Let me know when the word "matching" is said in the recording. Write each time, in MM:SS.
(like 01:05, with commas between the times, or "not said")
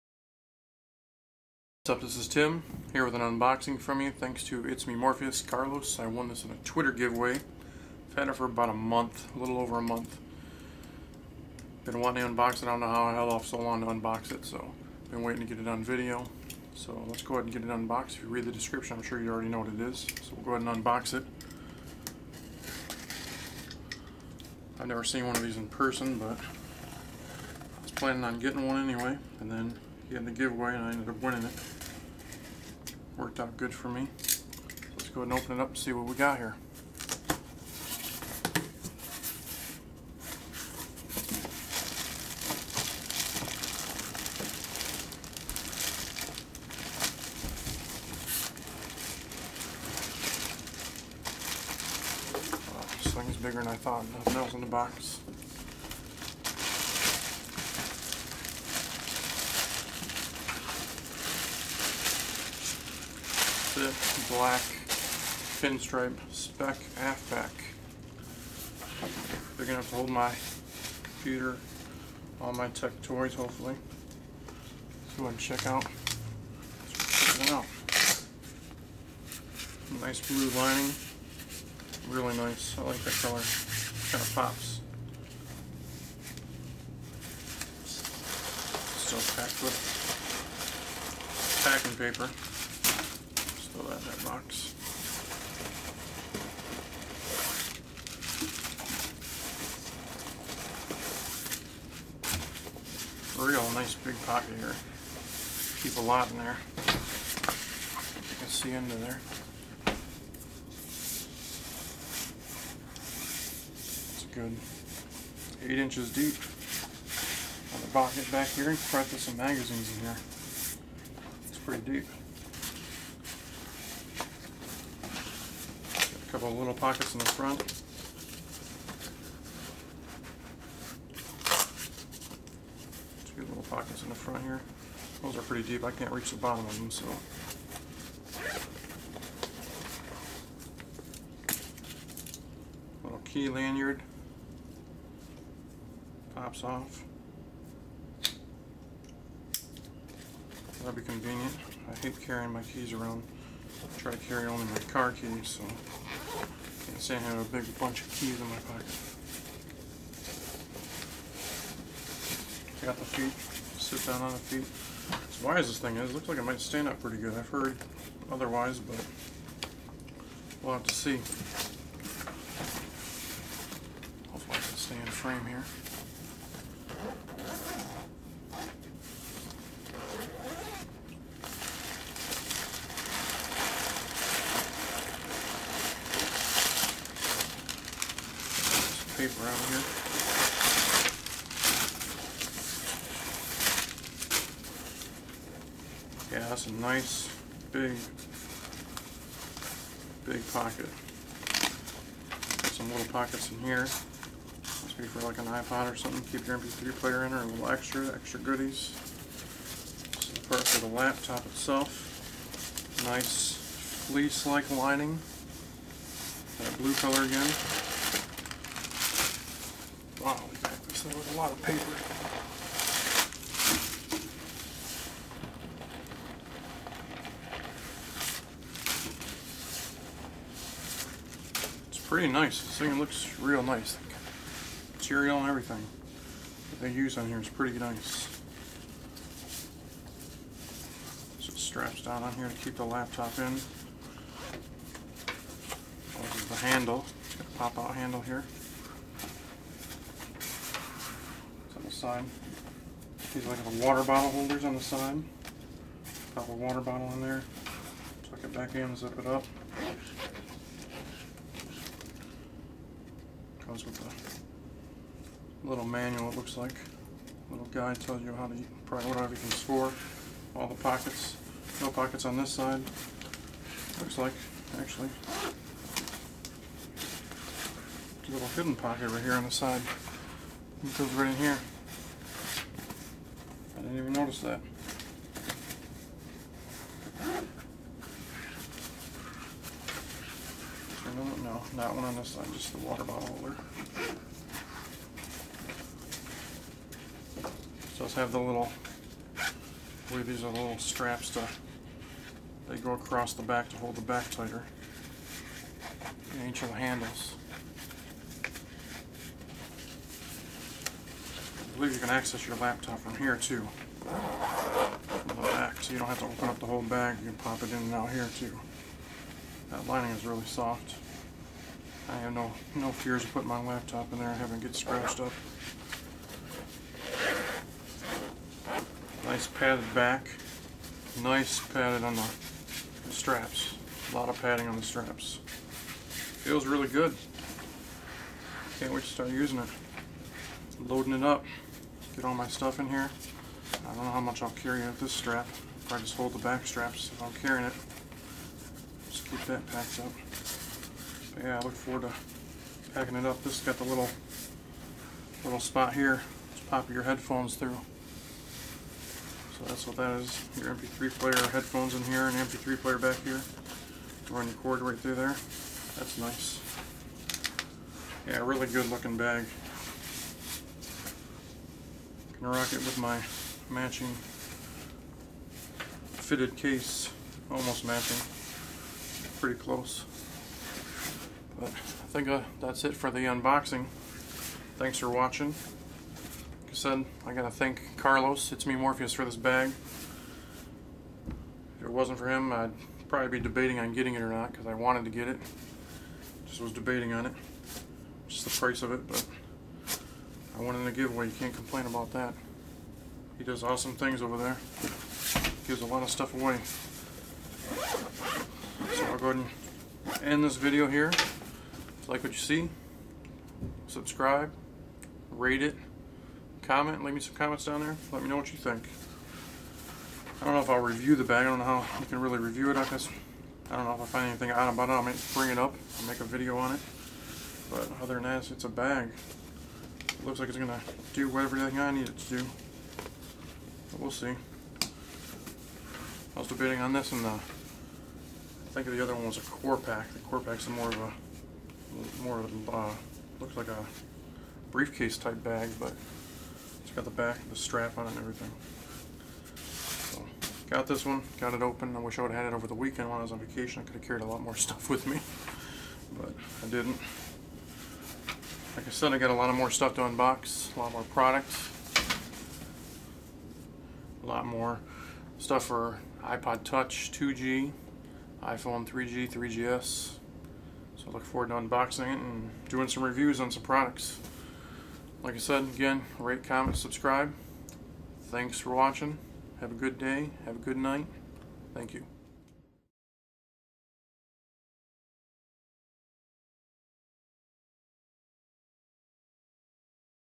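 06:13, 06:17.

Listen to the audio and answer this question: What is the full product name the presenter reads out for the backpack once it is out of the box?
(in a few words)
black pinstripe Speck AftPack.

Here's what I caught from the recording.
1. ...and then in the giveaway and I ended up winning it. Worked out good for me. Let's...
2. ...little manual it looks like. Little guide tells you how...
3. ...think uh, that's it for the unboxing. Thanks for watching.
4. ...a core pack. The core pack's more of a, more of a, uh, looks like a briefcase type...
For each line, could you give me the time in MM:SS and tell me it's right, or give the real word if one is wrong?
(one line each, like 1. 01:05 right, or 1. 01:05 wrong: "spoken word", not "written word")
1. 00:29 right
2. 04:25 right
3. 06:22 right
4. 07:19 right.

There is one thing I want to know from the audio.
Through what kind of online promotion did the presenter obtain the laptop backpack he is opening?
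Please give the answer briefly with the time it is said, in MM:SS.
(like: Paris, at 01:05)
Twitter giveaway, at 00:06.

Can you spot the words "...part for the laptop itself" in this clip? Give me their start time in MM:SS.
03:30.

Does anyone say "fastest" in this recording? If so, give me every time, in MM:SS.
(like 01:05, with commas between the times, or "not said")
not said.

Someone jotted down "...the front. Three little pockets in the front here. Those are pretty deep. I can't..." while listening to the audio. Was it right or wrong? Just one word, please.
wrong.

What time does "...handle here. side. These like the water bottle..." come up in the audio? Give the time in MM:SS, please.
04:07.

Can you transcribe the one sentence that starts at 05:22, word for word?
I have no, no fears of putting my laptop in there and having it get scratched up.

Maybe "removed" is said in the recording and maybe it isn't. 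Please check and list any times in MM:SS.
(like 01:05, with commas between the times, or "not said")
not said.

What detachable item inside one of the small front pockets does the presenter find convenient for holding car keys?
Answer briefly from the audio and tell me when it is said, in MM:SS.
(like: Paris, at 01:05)
key lanyard, at 02:23.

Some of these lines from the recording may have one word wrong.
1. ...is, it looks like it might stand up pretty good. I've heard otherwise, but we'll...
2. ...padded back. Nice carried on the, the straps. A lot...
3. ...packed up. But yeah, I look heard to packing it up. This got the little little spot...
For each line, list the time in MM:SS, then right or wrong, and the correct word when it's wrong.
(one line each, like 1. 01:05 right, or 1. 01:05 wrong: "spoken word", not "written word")
1. 02:45 right
2. 05:29 wrong: "padded", not "carried"
3. 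05:49 wrong: "forward", not "heard".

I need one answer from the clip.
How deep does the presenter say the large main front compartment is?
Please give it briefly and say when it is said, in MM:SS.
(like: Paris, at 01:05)
8 inches, at 01:55.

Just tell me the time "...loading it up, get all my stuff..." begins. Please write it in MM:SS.
05:40.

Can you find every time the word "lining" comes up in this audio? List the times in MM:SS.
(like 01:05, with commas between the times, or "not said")
01:20, 03:34, 05:19.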